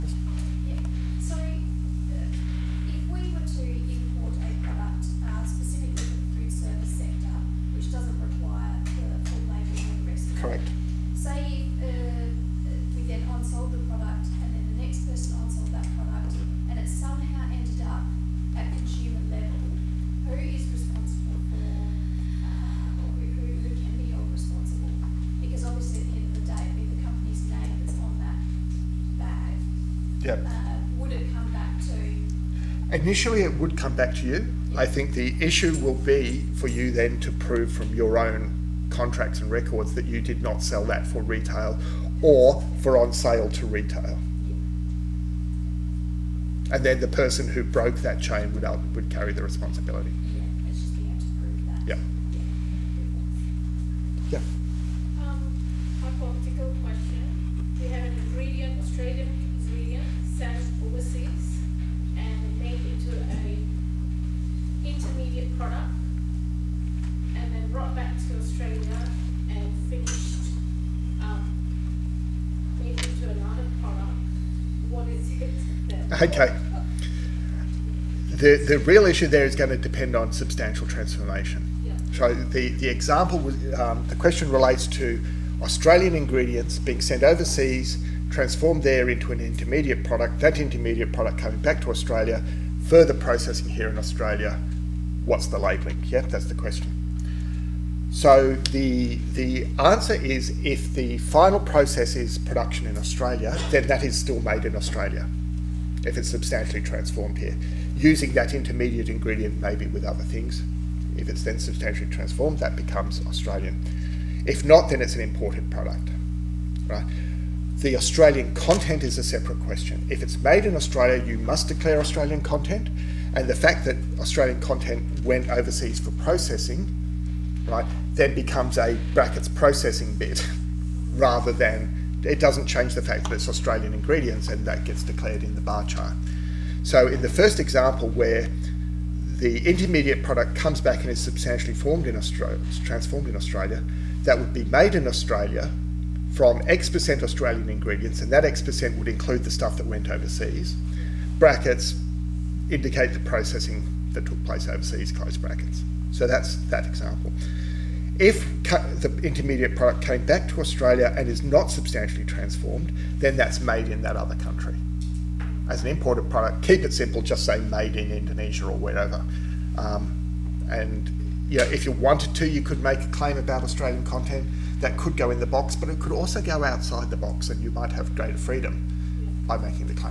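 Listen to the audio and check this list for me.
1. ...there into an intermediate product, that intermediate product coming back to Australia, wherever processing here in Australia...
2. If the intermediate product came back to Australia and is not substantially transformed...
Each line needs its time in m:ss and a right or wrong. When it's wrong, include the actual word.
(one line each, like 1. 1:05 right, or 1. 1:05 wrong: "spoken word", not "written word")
1. 1:28 wrong: "further", not "wherever"
2. 2:38 right.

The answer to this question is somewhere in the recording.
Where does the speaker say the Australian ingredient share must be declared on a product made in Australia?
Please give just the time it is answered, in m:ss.
2:15.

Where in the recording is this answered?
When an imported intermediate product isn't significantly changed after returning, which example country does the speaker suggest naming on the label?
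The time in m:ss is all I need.
2:48.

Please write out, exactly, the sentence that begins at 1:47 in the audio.
Using that intermediate ingredient maybe with other things, if it's then substantially transformed, that becomes Australian.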